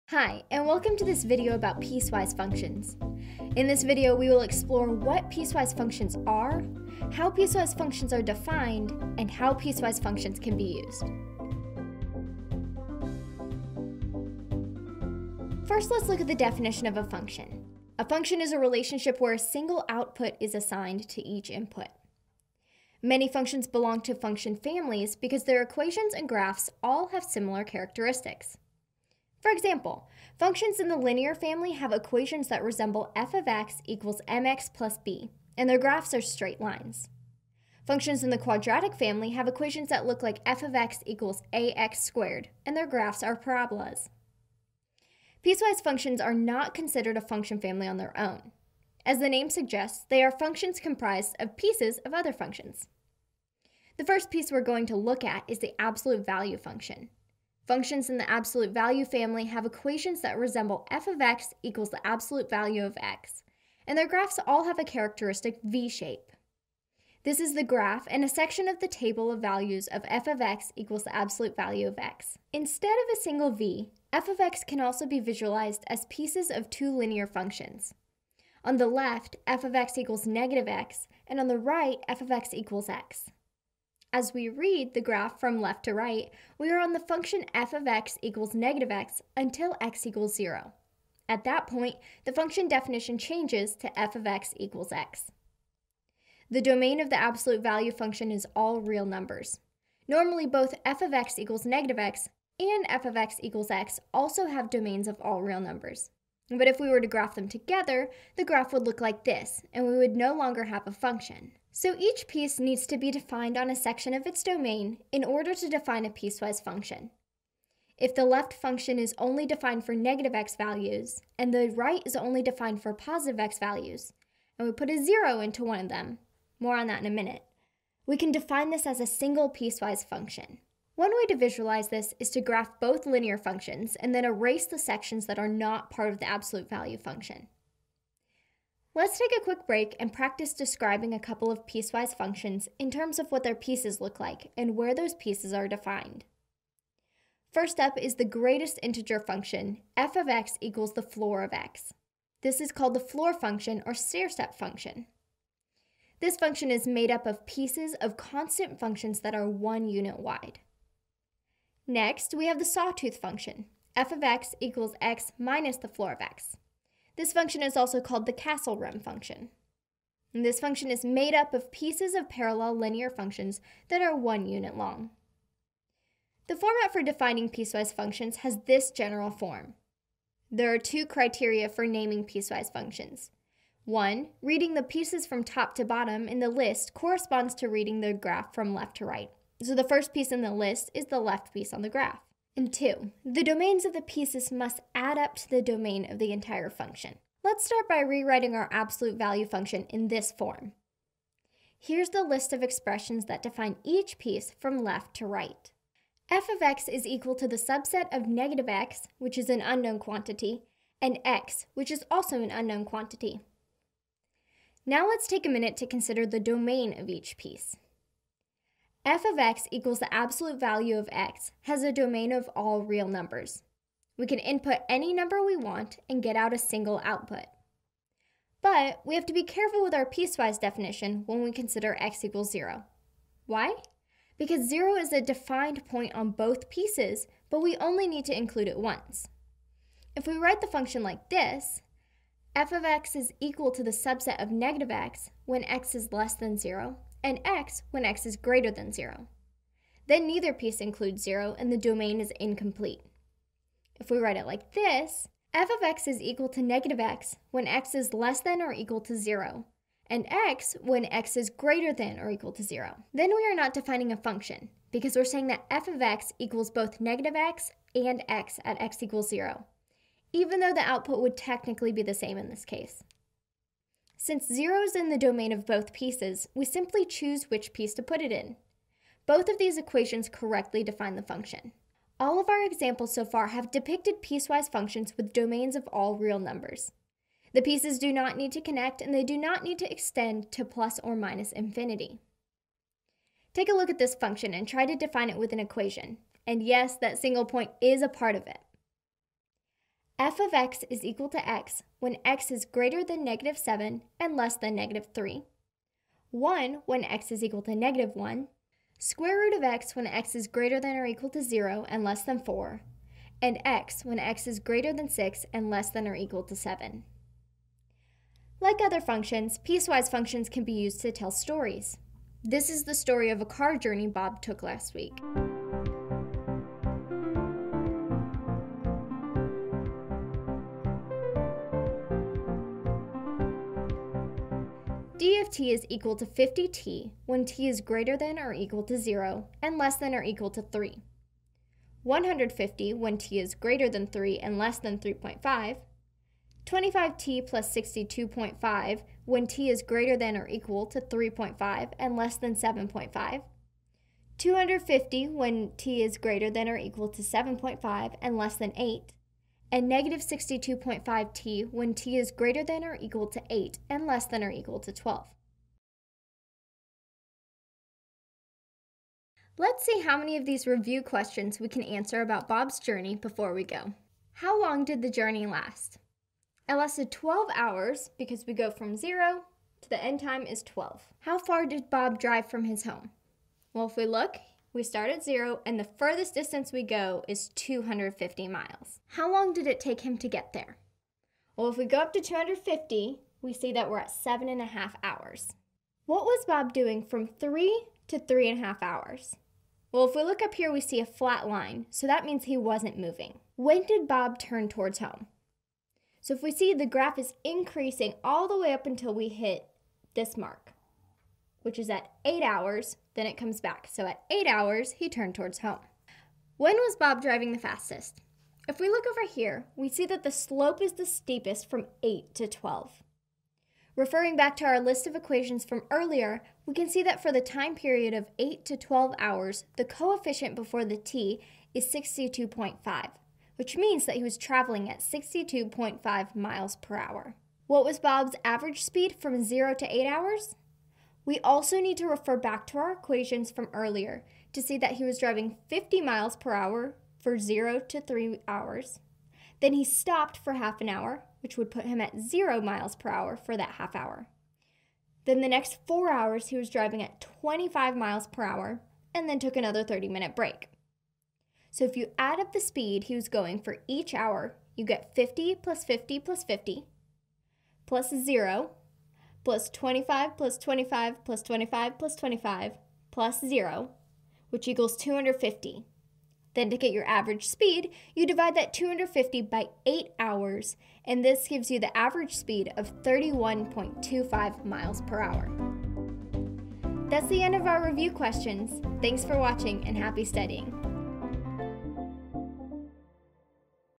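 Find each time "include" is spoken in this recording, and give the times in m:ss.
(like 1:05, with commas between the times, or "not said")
3:58, 4:10.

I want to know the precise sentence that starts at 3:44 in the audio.
We can input any number we want and get out a single output.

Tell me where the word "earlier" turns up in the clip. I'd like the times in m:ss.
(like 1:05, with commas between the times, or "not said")
7:05, 7:23.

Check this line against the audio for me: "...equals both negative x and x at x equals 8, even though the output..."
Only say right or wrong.
wrong.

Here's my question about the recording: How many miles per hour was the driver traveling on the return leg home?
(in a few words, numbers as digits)
62.5.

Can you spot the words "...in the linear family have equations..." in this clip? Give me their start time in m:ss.
0:30.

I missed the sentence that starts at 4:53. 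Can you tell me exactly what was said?
Take a look at this function and try to define it with an equation.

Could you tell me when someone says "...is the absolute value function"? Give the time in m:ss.
0:55.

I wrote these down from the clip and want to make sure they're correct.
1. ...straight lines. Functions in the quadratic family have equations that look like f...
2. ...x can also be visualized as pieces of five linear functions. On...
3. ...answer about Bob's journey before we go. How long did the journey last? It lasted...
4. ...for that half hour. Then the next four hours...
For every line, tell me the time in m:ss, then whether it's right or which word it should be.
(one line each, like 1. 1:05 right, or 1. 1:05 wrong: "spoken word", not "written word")
1. 0:36 right
2. 1:14 wrong: "two", not "five"
3. 6:11 right
4. 7:33 right.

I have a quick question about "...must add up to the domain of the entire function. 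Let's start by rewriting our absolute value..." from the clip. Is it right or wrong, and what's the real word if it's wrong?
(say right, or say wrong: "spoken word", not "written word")
right.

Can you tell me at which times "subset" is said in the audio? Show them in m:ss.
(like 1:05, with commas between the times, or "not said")
3:27, 4:03.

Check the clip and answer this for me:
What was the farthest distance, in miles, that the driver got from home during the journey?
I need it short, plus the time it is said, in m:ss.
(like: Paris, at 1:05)
250 miles, at 6:27.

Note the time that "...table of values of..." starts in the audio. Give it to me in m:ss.
1:08.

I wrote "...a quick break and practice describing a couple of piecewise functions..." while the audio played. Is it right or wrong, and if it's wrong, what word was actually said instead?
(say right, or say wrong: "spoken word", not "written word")
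right.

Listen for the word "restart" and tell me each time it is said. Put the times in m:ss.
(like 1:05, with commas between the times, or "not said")
not said.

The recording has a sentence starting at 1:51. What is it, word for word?
So each piece needs to be defined on a section of its domain in order to define a piecewise function.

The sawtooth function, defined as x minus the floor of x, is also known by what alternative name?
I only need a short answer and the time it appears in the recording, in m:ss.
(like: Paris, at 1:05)
castle rim function, at 2:48.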